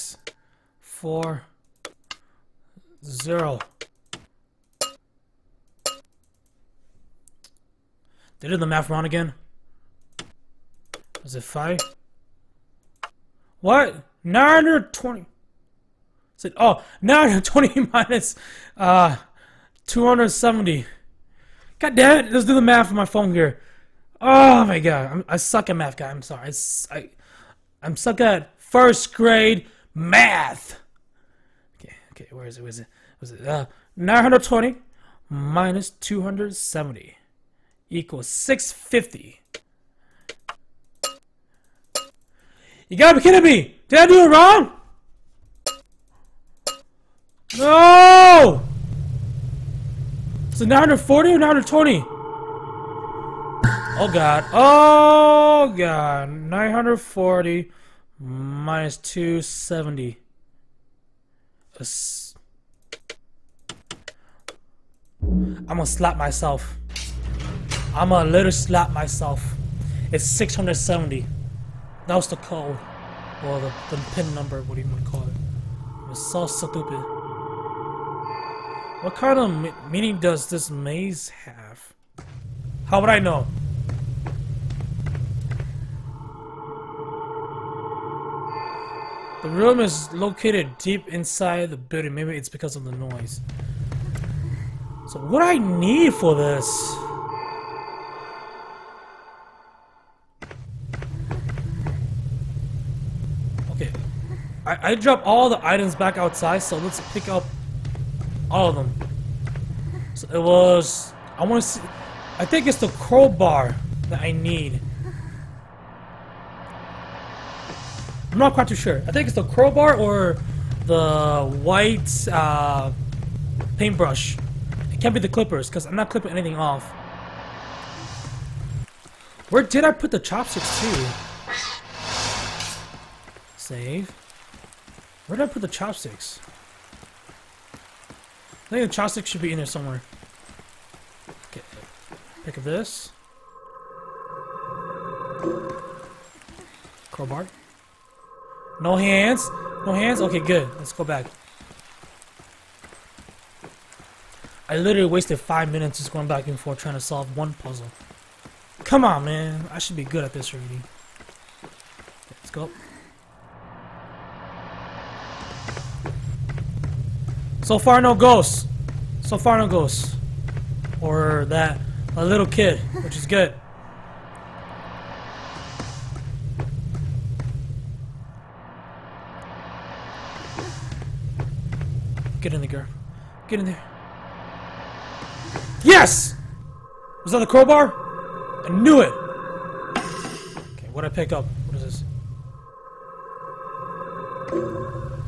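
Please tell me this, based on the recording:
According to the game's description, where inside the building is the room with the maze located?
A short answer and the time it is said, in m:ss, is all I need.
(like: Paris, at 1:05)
Deep inside the building, at 1:30.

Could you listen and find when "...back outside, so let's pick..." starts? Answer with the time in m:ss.
1:45.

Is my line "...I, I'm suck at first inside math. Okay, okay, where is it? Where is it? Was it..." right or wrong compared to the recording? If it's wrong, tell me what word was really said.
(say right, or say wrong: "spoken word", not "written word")
wrong: "grade", not "inside".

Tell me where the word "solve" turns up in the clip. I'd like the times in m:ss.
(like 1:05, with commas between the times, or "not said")
2:37.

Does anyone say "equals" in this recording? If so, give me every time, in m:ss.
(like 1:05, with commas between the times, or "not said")
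0:37.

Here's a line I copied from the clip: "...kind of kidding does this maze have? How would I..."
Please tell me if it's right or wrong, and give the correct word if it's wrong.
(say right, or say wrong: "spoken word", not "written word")
wrong: "meaning", not "kidding".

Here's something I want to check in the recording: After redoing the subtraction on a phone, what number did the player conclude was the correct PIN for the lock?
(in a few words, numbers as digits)
670.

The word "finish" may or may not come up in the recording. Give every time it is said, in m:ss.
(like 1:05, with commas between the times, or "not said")
not said.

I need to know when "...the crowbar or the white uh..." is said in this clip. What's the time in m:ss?
1:59.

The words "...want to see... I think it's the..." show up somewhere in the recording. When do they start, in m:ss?
1:51.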